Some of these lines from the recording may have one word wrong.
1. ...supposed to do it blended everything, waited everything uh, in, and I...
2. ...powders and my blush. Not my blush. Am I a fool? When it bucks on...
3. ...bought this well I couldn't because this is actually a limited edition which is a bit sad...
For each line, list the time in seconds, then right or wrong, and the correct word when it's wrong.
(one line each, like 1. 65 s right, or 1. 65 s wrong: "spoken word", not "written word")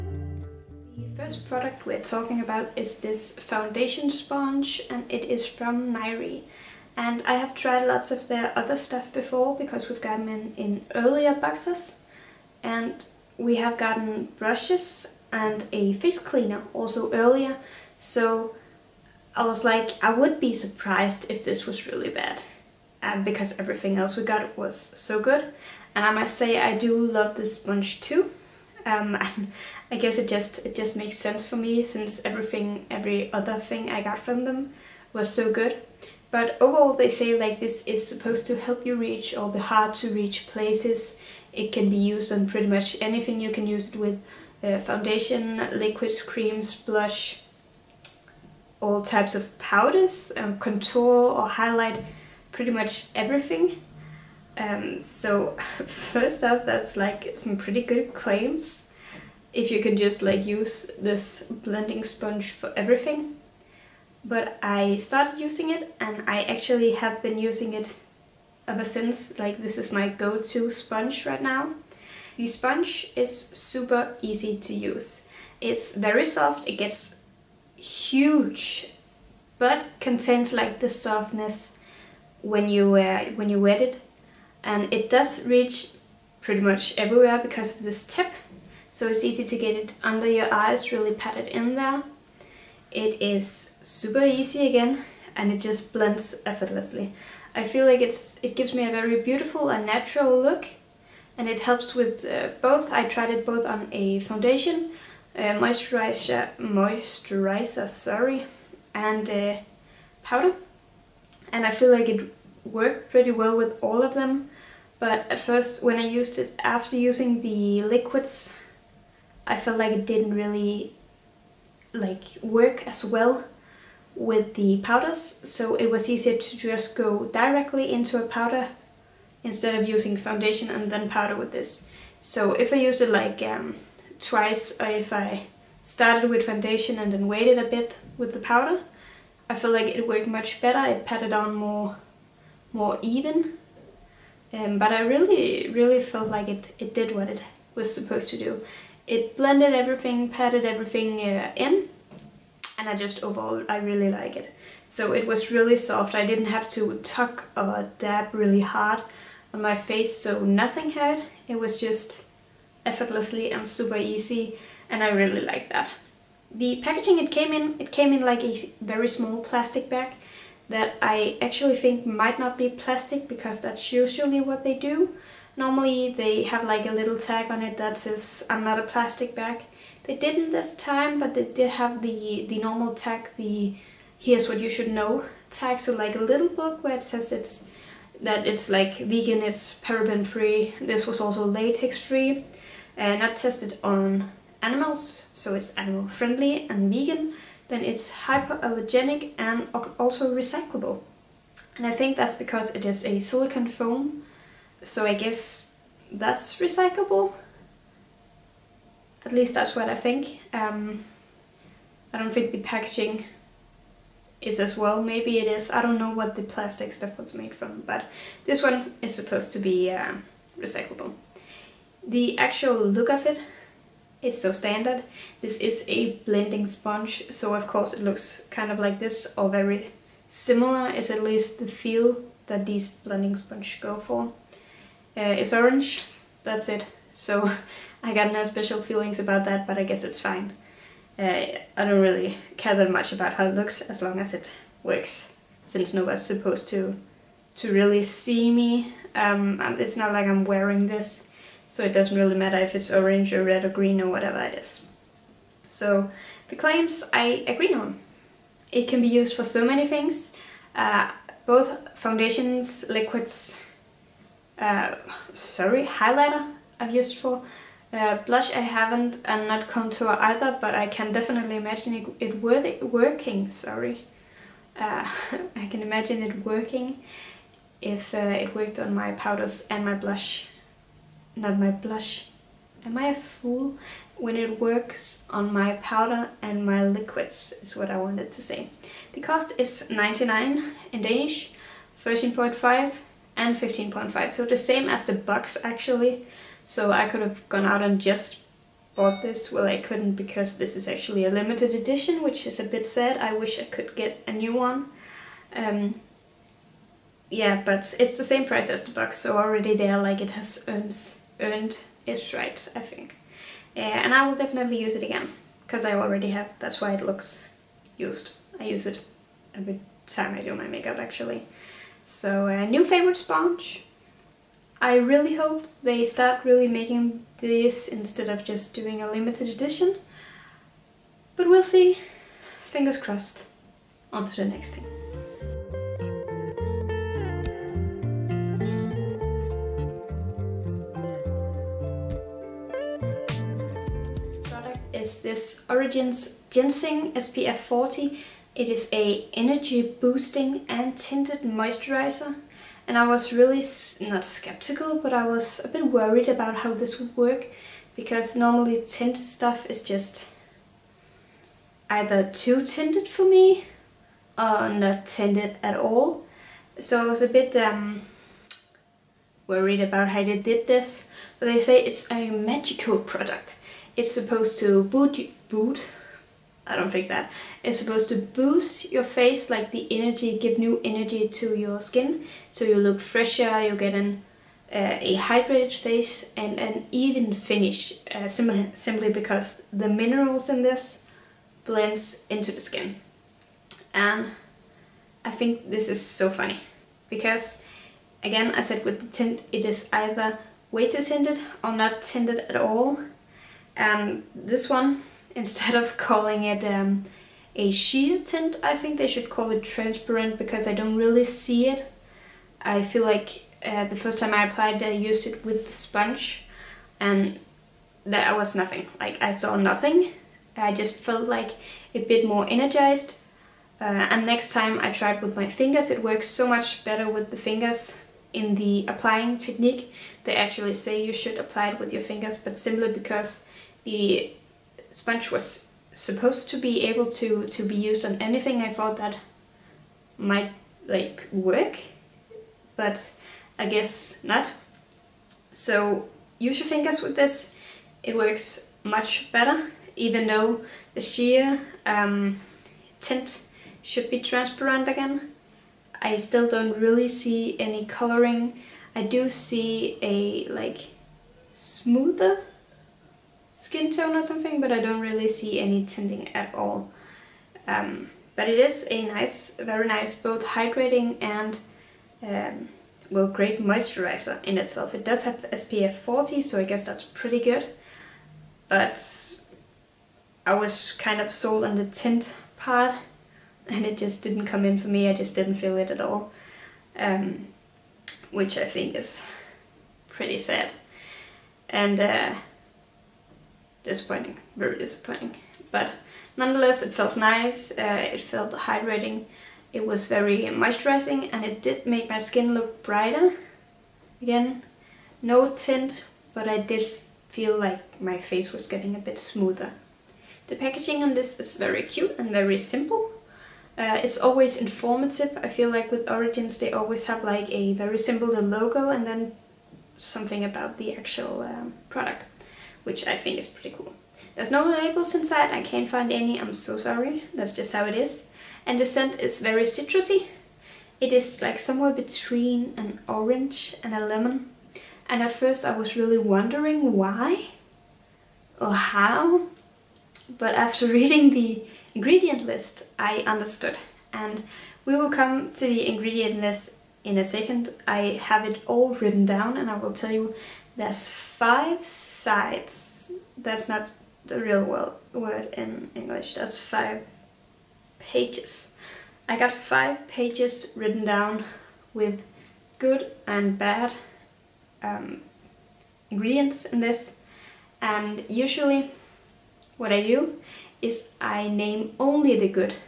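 1. 147 s wrong: "padded", not "waited"
2. 279 s wrong: "works", not "bucks"
3. 298 s right.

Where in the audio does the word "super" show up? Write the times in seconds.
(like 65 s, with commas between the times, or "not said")
73 s, 93 s, 163 s.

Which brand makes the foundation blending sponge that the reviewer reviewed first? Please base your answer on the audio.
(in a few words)
Niré.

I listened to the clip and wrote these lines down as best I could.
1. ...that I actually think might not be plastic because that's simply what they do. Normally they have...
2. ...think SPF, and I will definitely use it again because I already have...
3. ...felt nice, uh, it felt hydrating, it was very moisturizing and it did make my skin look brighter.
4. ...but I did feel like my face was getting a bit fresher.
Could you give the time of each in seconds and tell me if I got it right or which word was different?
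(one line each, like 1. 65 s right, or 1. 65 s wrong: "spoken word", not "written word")
1. 170 s wrong: "usually", not "simply"
2. 312 s wrong: "Yeah", not "SPF"
3. 496 s right
4. 506 s wrong: "smoother", not "fresher".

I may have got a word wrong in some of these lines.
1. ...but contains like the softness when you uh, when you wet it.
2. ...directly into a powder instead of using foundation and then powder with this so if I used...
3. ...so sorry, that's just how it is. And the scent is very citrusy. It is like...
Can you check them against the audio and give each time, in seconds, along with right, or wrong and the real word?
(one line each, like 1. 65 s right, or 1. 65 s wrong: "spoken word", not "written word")
1. 79 s right
2. 127 s right
3. 526 s right.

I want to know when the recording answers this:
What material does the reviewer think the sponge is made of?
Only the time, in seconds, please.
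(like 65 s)
203 s.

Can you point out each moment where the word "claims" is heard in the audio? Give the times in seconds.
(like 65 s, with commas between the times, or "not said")
58 s, 256 s.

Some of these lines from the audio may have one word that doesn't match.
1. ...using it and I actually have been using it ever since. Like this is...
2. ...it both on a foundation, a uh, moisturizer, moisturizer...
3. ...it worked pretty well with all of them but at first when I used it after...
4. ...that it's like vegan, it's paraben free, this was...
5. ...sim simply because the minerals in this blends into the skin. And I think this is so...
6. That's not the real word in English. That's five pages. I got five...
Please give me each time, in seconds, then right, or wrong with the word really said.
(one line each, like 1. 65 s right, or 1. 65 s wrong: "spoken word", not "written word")
1. 65 s right
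2. 103 s right
3. 112 s right
4. 188 s right
5. 388 s right
6. 553 s right.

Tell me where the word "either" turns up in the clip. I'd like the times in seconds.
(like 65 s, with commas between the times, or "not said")
270 s, 361 s, 399 s.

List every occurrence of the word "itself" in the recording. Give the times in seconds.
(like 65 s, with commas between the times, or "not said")
474 s.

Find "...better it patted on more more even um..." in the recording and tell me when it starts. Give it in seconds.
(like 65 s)
140 s.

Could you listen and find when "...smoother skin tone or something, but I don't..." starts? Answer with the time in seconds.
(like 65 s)
461 s.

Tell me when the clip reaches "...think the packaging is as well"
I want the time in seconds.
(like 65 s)
212 s.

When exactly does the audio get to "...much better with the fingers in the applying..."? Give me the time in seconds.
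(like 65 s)
426 s.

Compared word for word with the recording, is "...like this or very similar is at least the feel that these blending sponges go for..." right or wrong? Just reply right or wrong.
right.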